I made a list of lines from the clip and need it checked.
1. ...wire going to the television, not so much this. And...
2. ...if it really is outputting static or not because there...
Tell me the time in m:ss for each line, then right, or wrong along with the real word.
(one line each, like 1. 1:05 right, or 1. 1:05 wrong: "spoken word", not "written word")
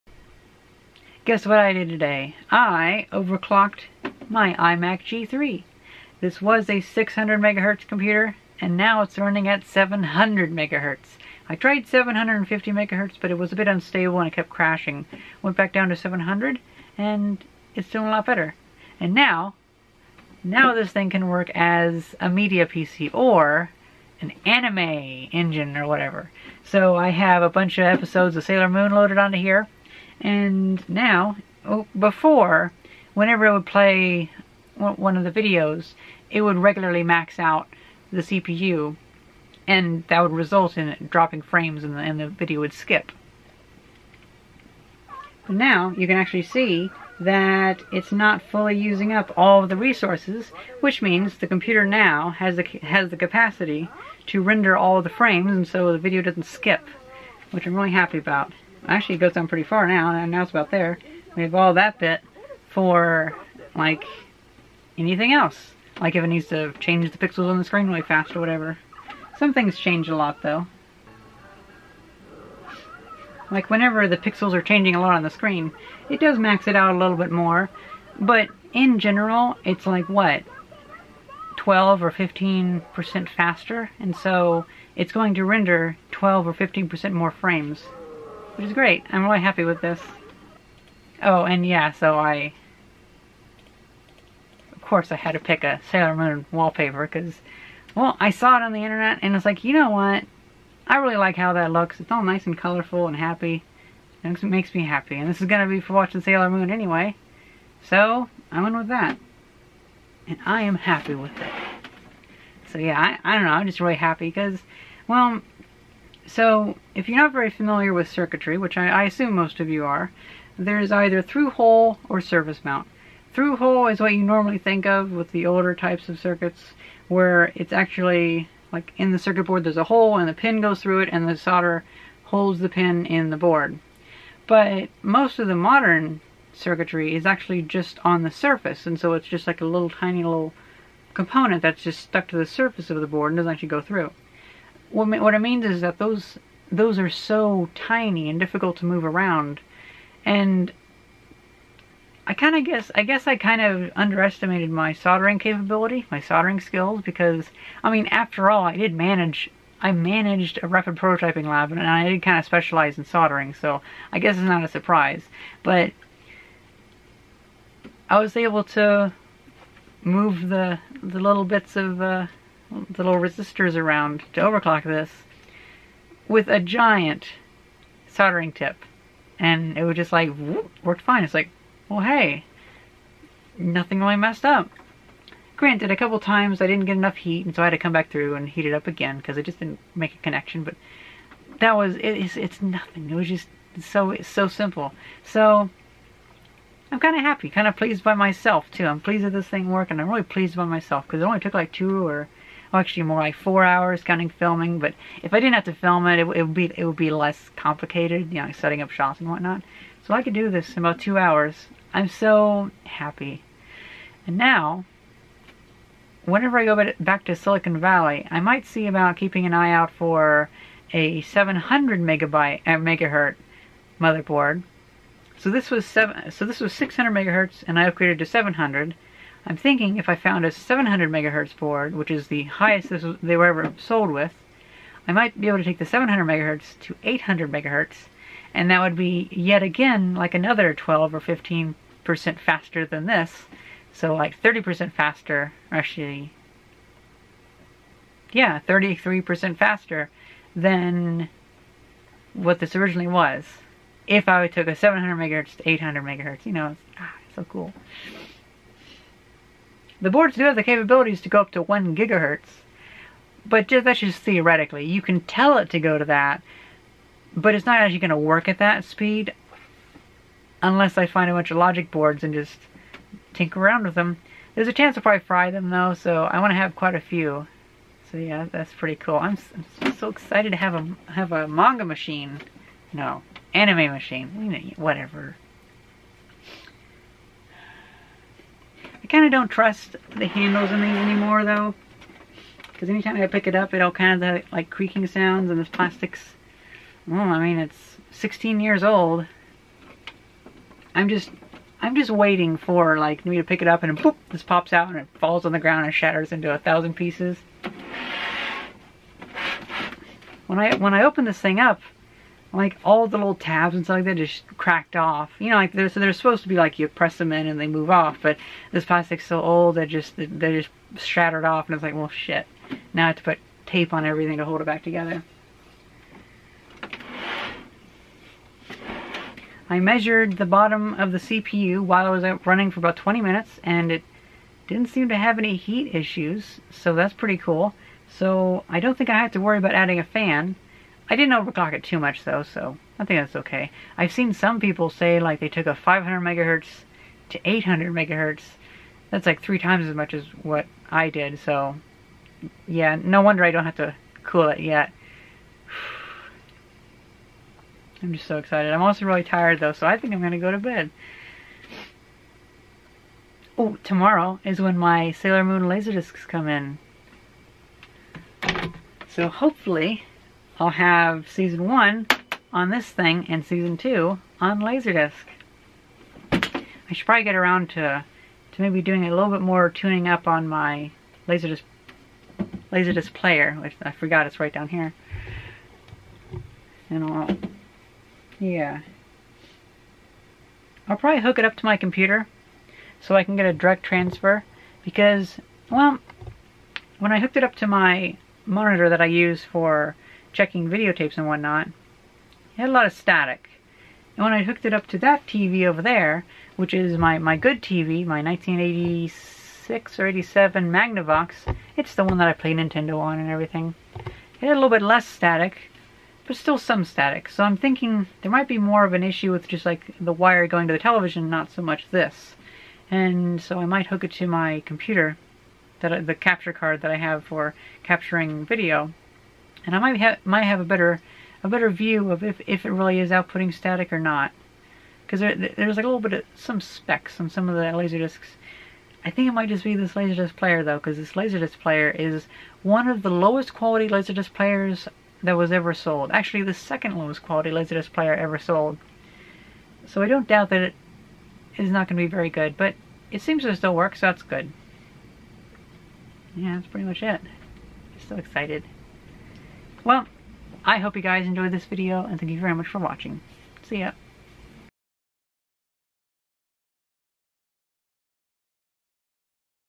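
1. 7:00 right
2. 7:12 right.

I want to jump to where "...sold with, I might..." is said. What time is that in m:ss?
3:53.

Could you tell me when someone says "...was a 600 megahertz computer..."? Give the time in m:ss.
0:06.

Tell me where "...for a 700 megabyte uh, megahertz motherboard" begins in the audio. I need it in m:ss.
3:39.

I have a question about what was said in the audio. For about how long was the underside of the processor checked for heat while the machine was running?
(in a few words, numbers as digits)
20 minutes.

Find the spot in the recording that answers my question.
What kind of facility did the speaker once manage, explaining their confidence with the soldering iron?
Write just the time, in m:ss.
2:40.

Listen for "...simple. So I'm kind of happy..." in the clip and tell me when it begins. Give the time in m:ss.
3:14.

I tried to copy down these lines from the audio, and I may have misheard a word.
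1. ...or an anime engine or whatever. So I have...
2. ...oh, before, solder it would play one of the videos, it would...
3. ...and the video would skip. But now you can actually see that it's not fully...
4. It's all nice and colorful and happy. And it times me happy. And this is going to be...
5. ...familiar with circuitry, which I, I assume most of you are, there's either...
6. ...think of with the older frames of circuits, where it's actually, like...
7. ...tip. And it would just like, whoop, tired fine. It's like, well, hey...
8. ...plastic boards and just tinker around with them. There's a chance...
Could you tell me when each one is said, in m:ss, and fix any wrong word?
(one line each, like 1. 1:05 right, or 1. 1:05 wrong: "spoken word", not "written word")
1. 0:23 right
2. 0:31 wrong: "whenever", not "solder"
3. 0:41 right
4. 1:41 wrong: "makes", not "times"
5. 1:57 right
6. 2:04 wrong: "types", not "frames"
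7. 2:58 wrong: "worked", not "tired"
8. 4:31 wrong: "logic", not "plastic".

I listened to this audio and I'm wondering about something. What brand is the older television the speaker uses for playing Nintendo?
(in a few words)
Magnavox.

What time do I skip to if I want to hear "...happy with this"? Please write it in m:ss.
1:29.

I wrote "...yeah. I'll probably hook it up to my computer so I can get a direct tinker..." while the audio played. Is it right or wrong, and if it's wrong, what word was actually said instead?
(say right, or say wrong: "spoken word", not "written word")
wrong: "transfer", not "tinker".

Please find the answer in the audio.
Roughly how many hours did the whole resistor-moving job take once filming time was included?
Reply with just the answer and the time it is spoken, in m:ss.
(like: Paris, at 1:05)
4, at 3:23.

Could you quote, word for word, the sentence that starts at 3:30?
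So I could do this in about two hours.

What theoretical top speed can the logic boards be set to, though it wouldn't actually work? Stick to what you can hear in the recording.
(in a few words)
1 gigahertz.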